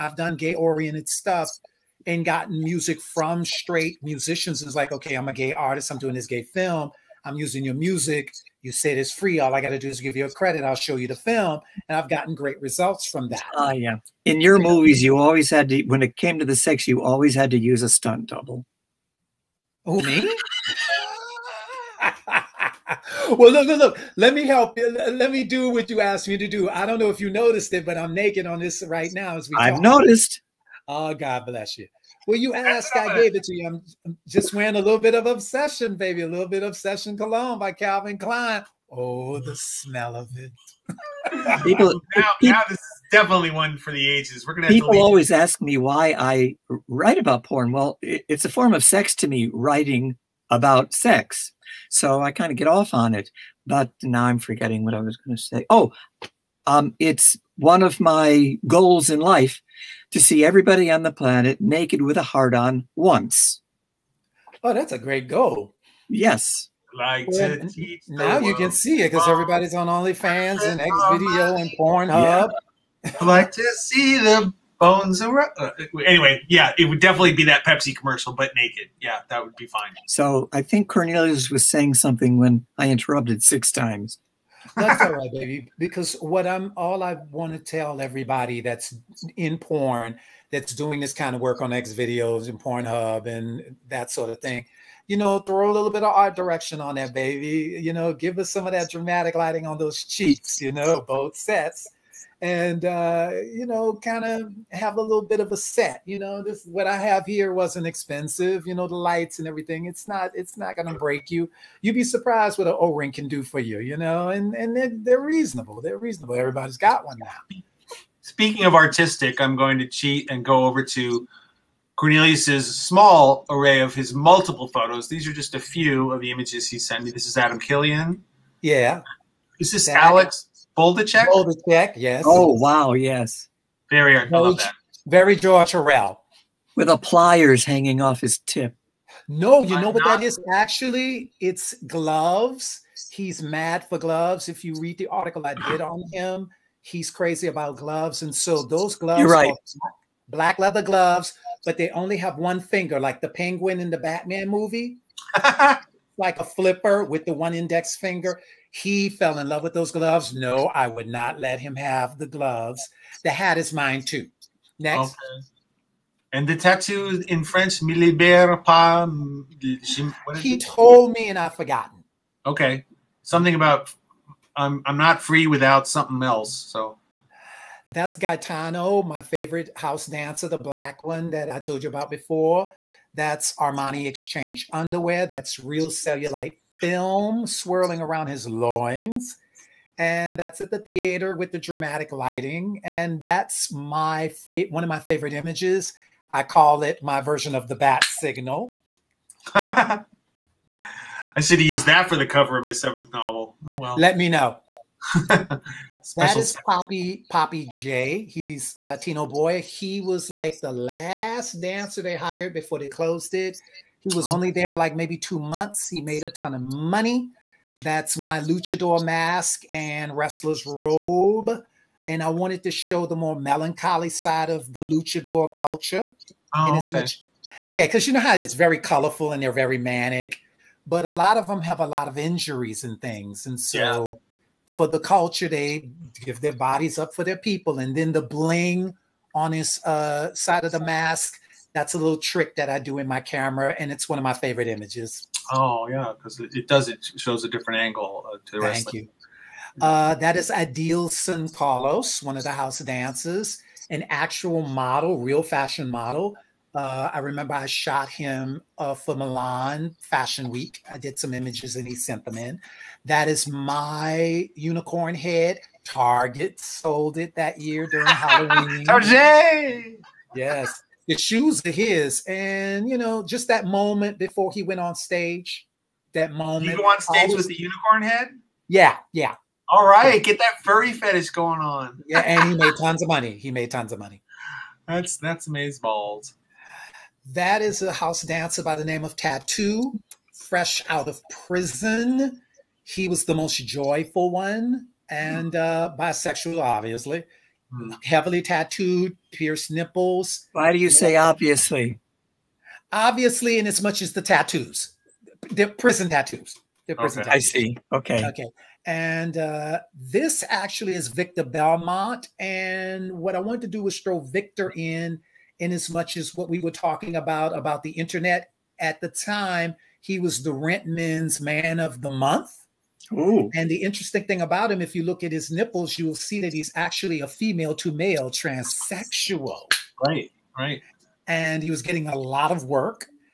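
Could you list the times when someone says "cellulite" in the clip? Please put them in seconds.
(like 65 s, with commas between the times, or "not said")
185 s.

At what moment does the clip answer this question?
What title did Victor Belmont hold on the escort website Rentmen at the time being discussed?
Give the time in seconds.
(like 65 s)
321 s.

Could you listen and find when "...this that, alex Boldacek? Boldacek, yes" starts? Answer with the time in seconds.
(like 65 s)
129 s.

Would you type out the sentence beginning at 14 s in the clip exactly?
In your movies, you always had to, when it came to the sex, you always had to use a stunt double.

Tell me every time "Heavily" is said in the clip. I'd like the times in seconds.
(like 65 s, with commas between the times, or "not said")
298 s.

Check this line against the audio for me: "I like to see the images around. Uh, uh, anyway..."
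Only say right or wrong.
wrong.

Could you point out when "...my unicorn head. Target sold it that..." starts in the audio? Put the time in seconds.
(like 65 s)
263 s.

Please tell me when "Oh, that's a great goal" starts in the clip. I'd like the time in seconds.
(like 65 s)
64 s.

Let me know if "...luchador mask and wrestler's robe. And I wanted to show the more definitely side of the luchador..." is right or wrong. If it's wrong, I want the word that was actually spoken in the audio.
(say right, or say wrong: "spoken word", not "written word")
wrong: "melancholy", not "definitely".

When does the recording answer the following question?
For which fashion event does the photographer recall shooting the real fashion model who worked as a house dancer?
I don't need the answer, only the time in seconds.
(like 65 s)
259 s.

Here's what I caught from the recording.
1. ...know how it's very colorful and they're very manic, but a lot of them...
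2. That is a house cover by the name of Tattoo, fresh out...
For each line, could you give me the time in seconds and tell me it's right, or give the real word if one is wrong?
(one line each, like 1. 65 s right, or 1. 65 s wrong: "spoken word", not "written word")
1. 228 s right
2. 287 s wrong: "dancer", not "cover".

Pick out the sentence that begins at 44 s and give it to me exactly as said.
people always ask me why I write about porn.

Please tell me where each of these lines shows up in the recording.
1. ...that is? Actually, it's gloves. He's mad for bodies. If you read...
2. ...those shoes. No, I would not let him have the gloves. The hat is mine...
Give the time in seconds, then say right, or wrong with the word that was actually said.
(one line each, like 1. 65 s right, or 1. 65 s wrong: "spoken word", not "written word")
1. 140 s wrong: "gloves", not "bodies"
2. 159 s wrong: "gloves", not "shoes".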